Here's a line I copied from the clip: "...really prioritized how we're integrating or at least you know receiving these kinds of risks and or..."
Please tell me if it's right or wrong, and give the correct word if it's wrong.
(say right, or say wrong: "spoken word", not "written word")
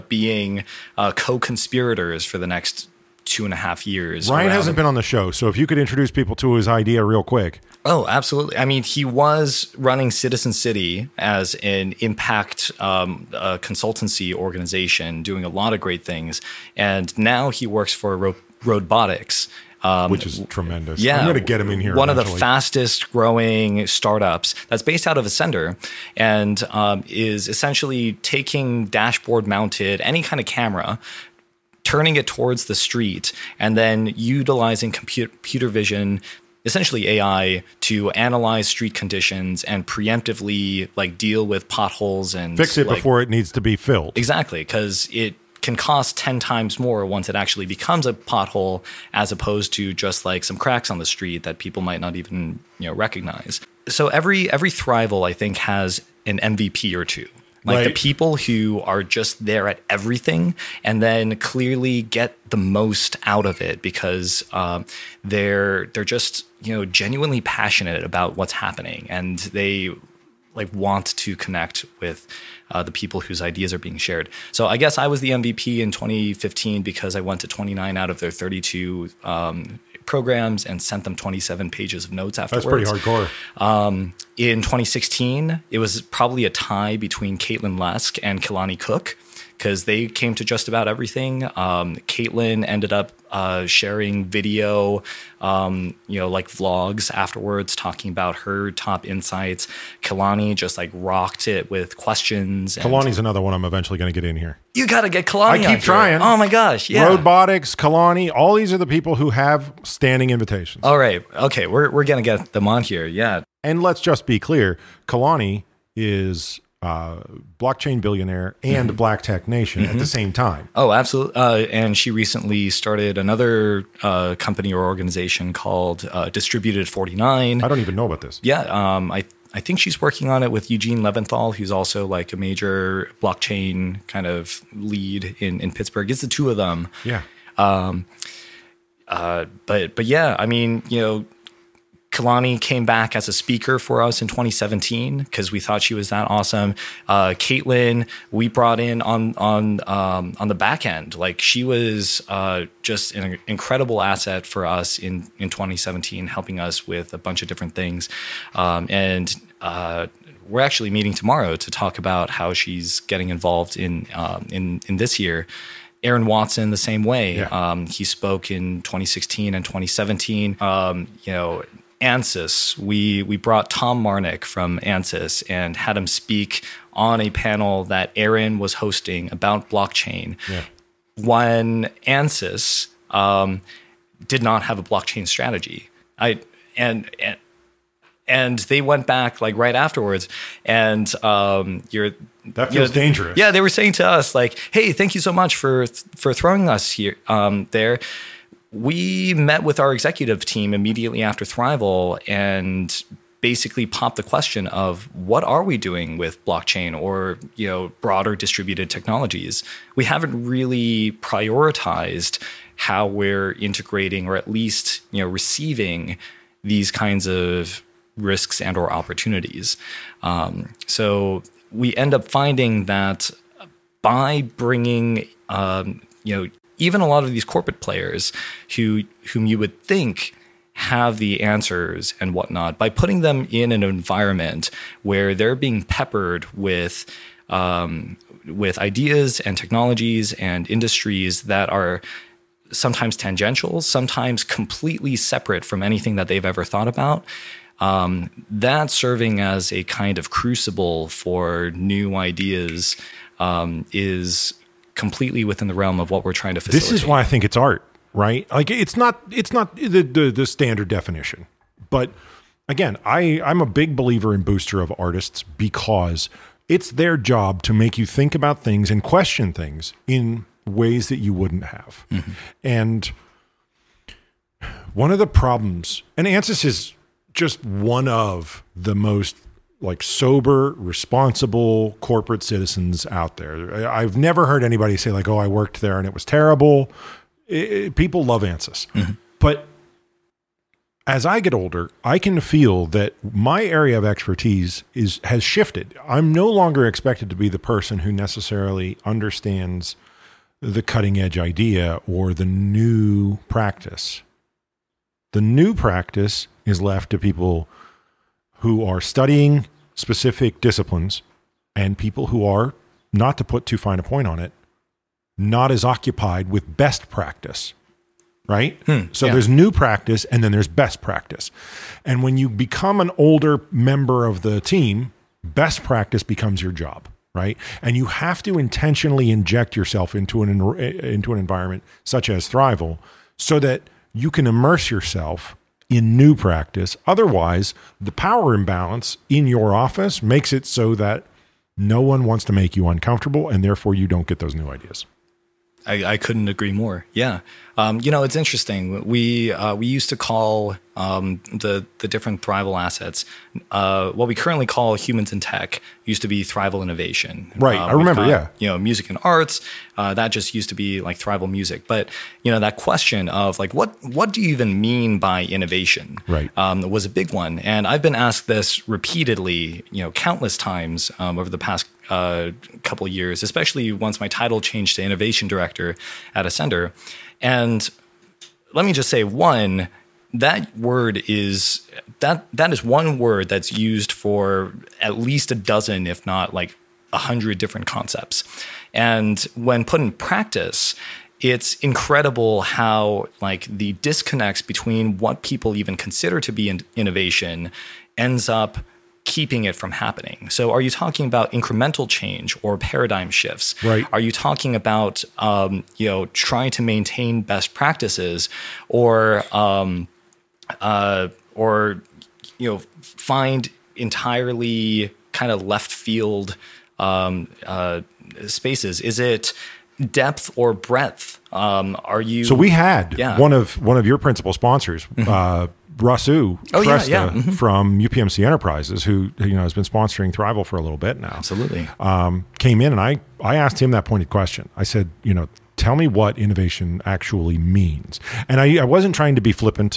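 right.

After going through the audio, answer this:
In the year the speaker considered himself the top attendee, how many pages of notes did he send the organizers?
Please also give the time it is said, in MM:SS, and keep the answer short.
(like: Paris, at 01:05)
27, at 01:21.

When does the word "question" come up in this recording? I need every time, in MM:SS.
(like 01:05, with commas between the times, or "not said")
01:41, 03:24, 04:29, 06:02, 07:14.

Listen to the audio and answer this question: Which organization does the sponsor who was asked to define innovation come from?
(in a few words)
UPMC Enterprises.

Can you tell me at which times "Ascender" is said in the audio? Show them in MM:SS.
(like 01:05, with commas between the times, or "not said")
00:25, 06:16.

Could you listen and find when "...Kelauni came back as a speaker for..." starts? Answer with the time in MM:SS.
02:22.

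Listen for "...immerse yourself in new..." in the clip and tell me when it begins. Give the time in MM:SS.
05:34.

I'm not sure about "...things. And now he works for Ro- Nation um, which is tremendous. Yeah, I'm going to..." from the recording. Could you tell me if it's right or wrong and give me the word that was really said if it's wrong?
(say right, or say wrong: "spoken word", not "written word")
wrong: "RoadBotics", not "Nation".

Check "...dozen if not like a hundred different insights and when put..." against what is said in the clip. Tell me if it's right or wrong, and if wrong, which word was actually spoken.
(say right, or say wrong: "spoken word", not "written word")
wrong: "concepts", not "insights".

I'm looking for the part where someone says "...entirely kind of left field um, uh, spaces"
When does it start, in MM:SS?
06:53.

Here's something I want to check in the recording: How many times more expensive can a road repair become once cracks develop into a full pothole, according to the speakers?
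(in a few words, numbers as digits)
10.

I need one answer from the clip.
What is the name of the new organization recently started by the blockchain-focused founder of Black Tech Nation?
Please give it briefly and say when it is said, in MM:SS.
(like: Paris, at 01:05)
Distributed 49, at 02:06.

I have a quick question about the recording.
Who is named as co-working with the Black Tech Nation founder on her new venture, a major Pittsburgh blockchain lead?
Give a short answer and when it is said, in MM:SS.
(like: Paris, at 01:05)
Eugene Leventhal, at 02:10.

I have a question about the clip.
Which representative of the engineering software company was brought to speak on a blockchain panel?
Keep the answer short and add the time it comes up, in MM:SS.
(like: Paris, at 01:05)
Tom Marnick, at 02:53.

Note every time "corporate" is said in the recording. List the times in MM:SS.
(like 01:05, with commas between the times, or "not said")
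03:47, 04:41.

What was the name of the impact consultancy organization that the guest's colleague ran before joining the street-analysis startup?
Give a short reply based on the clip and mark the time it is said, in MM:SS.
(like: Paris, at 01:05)
Citizen City, at 00:10.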